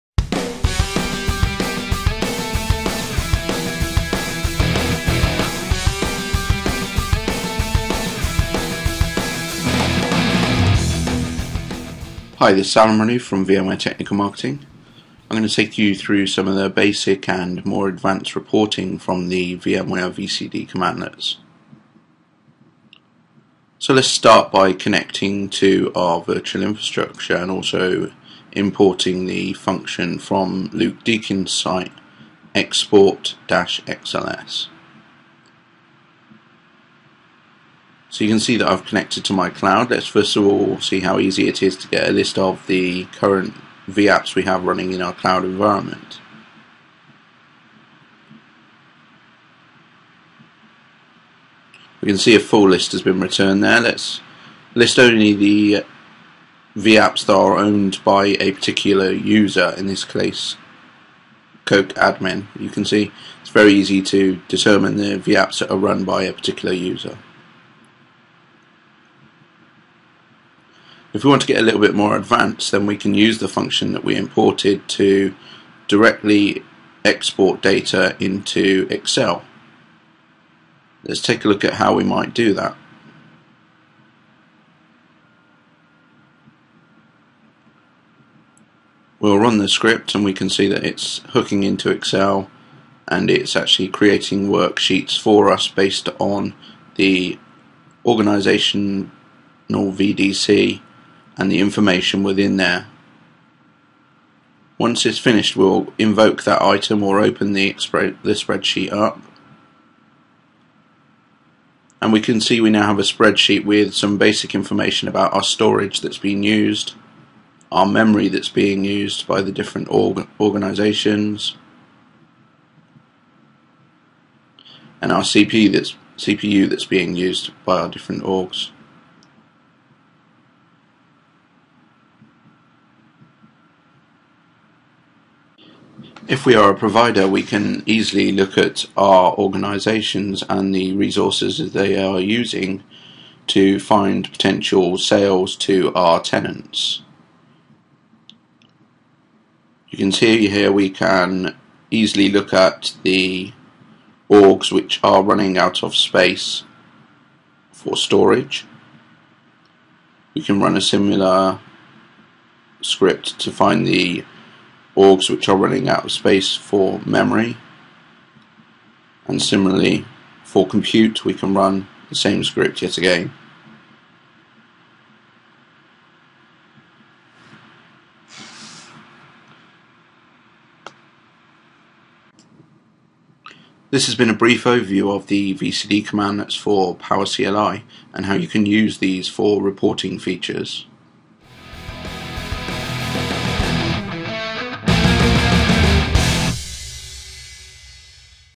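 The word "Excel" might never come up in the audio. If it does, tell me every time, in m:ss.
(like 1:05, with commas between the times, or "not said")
1:18, 1:31.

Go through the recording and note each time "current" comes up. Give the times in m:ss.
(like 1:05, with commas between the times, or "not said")
0:43.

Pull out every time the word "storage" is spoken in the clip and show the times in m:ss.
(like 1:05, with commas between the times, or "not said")
1:55, 2:37.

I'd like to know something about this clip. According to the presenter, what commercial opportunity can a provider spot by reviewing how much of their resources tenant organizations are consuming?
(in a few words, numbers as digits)
potential sales.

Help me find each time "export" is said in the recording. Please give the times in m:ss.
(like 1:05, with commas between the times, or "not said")
0:32, 1:17.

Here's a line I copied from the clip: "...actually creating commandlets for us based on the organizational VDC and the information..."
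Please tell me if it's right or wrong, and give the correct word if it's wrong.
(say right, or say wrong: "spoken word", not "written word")
wrong: "worksheets", not "commandlets".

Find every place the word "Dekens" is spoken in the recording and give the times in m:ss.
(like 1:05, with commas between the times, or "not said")
0:31.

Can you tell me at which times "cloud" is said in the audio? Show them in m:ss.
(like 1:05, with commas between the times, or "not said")
0:39, 0:45.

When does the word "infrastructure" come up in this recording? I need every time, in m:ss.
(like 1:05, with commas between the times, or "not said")
0:26.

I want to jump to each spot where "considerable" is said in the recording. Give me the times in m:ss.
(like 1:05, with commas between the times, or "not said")
not said.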